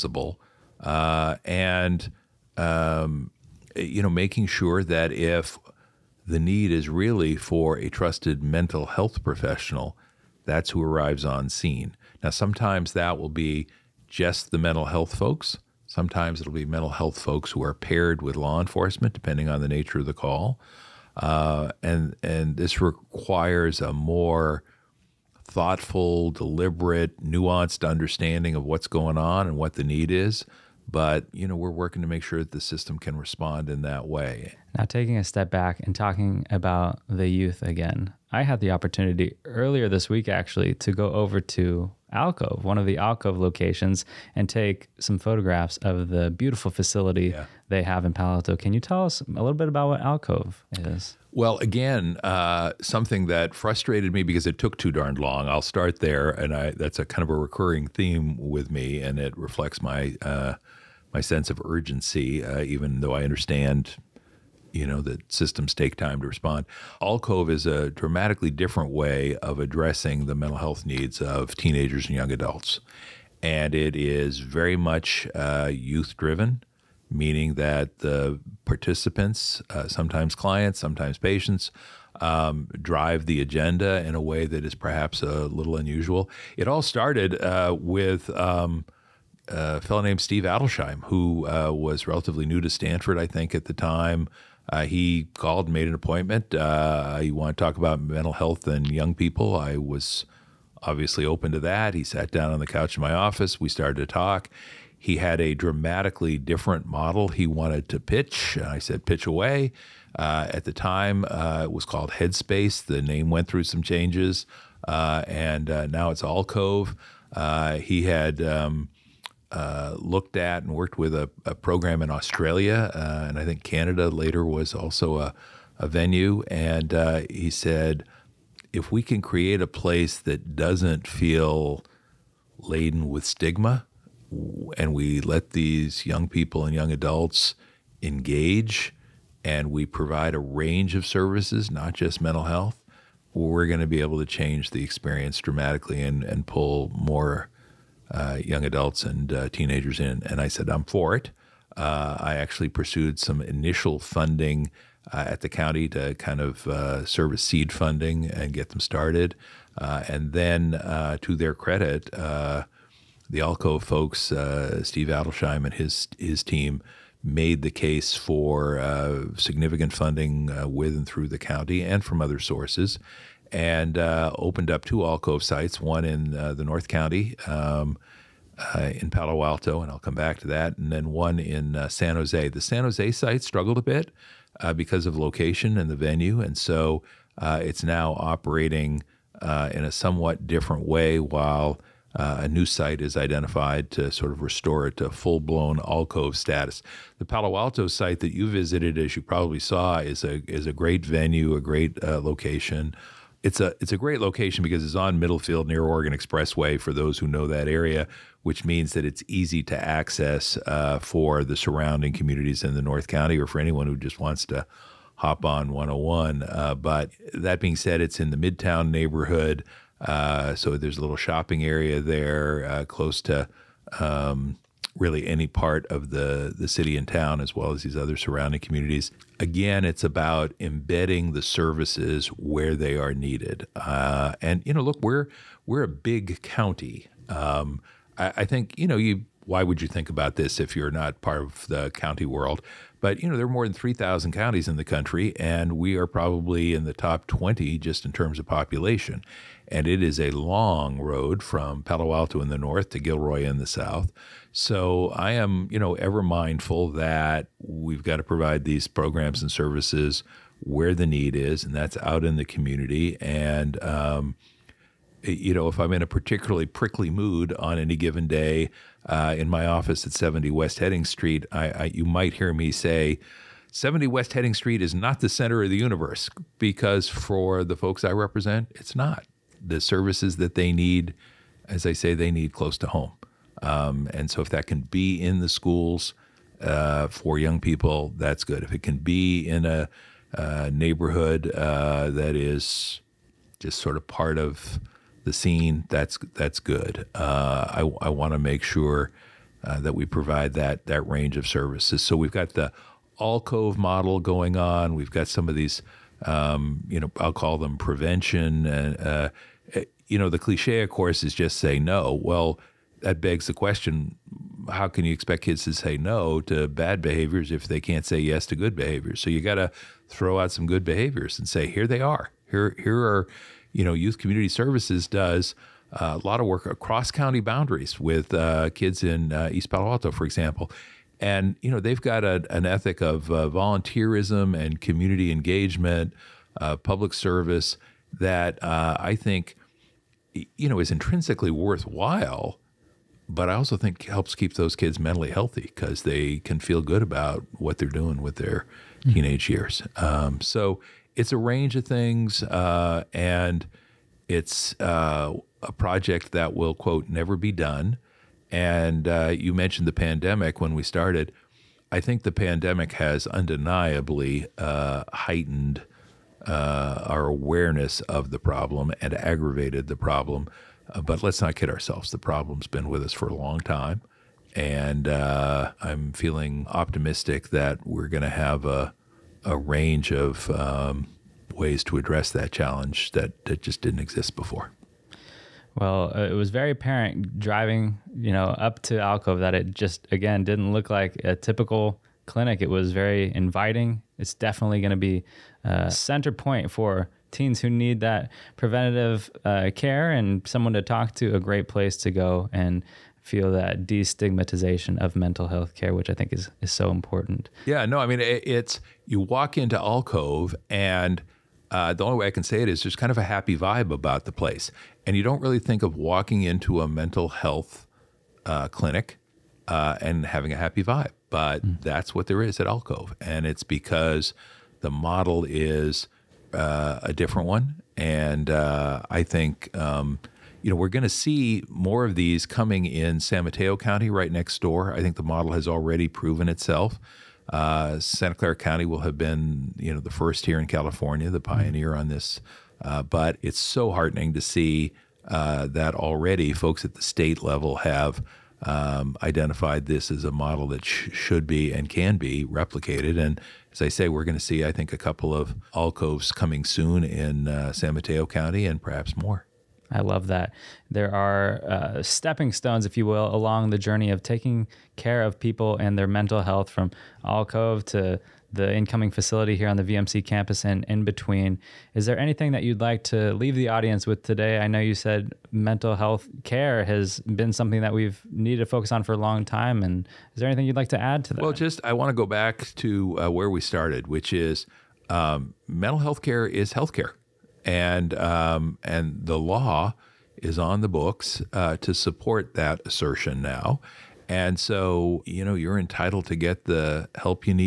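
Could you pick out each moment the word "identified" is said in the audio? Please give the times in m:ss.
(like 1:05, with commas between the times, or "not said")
3:13, 7:29.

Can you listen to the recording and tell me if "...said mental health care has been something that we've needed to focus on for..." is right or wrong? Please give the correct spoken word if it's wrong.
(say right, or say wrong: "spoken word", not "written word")
right.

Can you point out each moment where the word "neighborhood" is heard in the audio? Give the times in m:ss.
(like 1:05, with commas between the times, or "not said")
3:38, 4:50.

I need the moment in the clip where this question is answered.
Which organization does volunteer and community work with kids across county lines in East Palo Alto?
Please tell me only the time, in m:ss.
5:23.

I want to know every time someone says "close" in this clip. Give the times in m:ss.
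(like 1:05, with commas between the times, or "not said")
3:42, 4:42.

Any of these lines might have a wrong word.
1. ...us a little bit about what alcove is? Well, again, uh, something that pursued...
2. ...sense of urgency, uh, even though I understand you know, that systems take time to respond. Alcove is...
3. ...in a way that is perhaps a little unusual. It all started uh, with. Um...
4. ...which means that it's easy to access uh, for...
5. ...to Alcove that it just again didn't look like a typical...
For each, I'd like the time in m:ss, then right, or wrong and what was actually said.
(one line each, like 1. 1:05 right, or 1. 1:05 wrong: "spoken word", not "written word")
1. 0:49 wrong: "frustrated", not "pursued"
2. 1:01 right
3. 1:24 right
4. 3:28 right
5. 6:28 right.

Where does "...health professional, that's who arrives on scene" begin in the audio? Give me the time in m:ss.
0:08.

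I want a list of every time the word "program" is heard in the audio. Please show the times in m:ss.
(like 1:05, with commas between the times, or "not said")
2:01, 4:18.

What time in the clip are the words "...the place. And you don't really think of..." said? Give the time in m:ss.
6:54.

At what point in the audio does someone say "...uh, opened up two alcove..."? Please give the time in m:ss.
2:53.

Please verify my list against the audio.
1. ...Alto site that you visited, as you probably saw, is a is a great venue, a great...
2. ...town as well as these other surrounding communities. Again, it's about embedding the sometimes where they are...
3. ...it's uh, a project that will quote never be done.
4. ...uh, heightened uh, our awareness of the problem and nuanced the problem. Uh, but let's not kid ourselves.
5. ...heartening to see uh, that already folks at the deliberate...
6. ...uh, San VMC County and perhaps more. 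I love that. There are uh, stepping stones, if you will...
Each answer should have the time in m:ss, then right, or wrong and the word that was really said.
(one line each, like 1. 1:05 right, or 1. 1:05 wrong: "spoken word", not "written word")
1. 3:17 right
2. 3:47 wrong: "services", not "sometimes"
3. 5:54 right
4. 6:04 wrong: "aggravated", not "nuanced"
5. 7:23 wrong: "state", not "deliberate"
6. 7:37 wrong: "Mateo", not "VMC".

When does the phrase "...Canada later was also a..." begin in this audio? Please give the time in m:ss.
2:03.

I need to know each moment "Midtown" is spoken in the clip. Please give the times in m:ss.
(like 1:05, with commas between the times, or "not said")
3:38.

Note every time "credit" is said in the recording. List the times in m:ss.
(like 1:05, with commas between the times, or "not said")
2:41.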